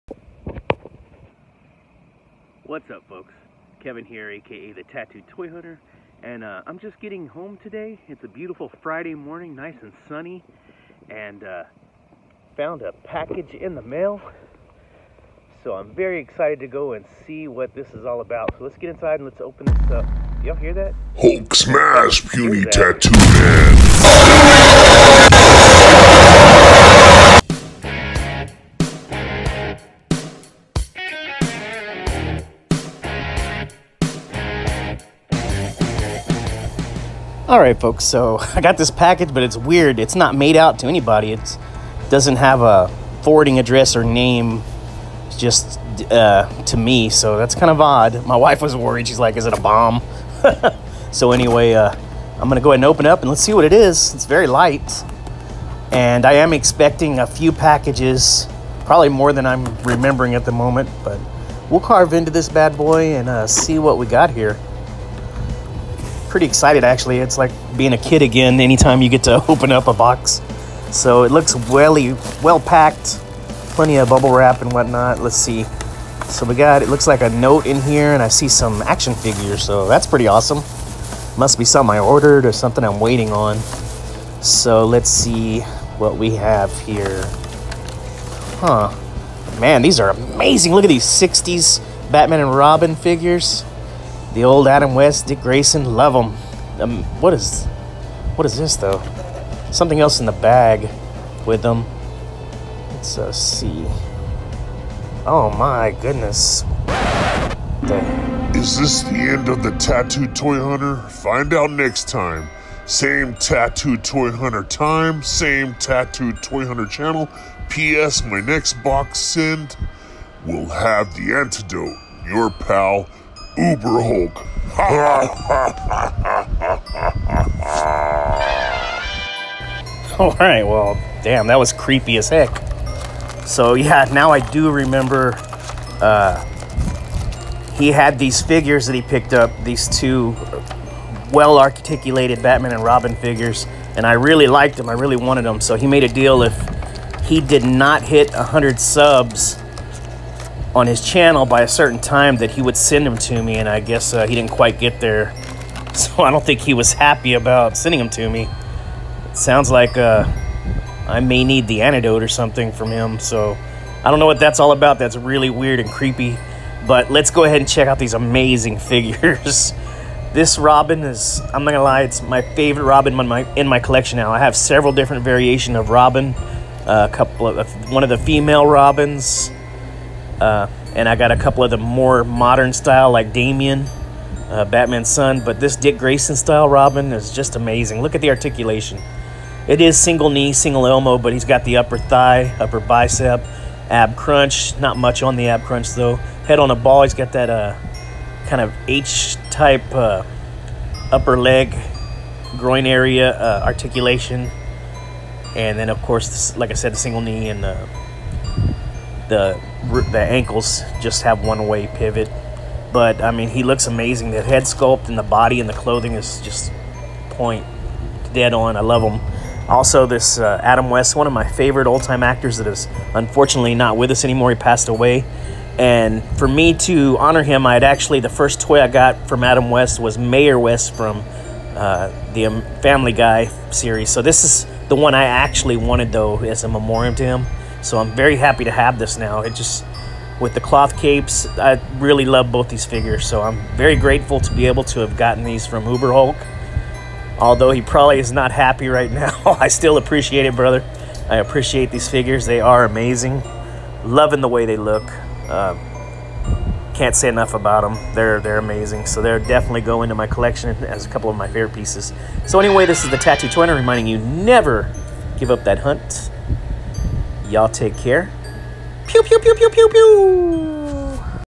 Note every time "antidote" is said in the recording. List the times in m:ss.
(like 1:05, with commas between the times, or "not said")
2:01, 2:41.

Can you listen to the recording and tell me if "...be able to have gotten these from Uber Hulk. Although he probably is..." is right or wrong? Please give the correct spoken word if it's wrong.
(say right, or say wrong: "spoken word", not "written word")
right.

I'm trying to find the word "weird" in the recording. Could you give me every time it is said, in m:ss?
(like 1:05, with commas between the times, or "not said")
0:39, 2:45.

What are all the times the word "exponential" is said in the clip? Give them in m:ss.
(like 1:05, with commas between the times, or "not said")
not said.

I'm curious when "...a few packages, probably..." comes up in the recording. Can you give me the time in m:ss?
0:57.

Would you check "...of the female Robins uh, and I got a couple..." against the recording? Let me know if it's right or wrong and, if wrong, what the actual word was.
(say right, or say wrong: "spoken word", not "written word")
right.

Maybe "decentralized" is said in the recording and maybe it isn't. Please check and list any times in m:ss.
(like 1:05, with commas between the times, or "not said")
not said.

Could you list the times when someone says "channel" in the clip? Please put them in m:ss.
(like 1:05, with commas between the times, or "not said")
1:56, 2:31.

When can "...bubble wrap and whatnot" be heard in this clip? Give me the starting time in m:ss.
1:14.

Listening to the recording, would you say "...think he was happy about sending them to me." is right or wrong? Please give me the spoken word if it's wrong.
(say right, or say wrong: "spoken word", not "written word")
right.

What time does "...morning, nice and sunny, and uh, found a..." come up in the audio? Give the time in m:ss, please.
0:09.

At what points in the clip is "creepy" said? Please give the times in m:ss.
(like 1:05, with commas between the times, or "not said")
2:11, 2:45.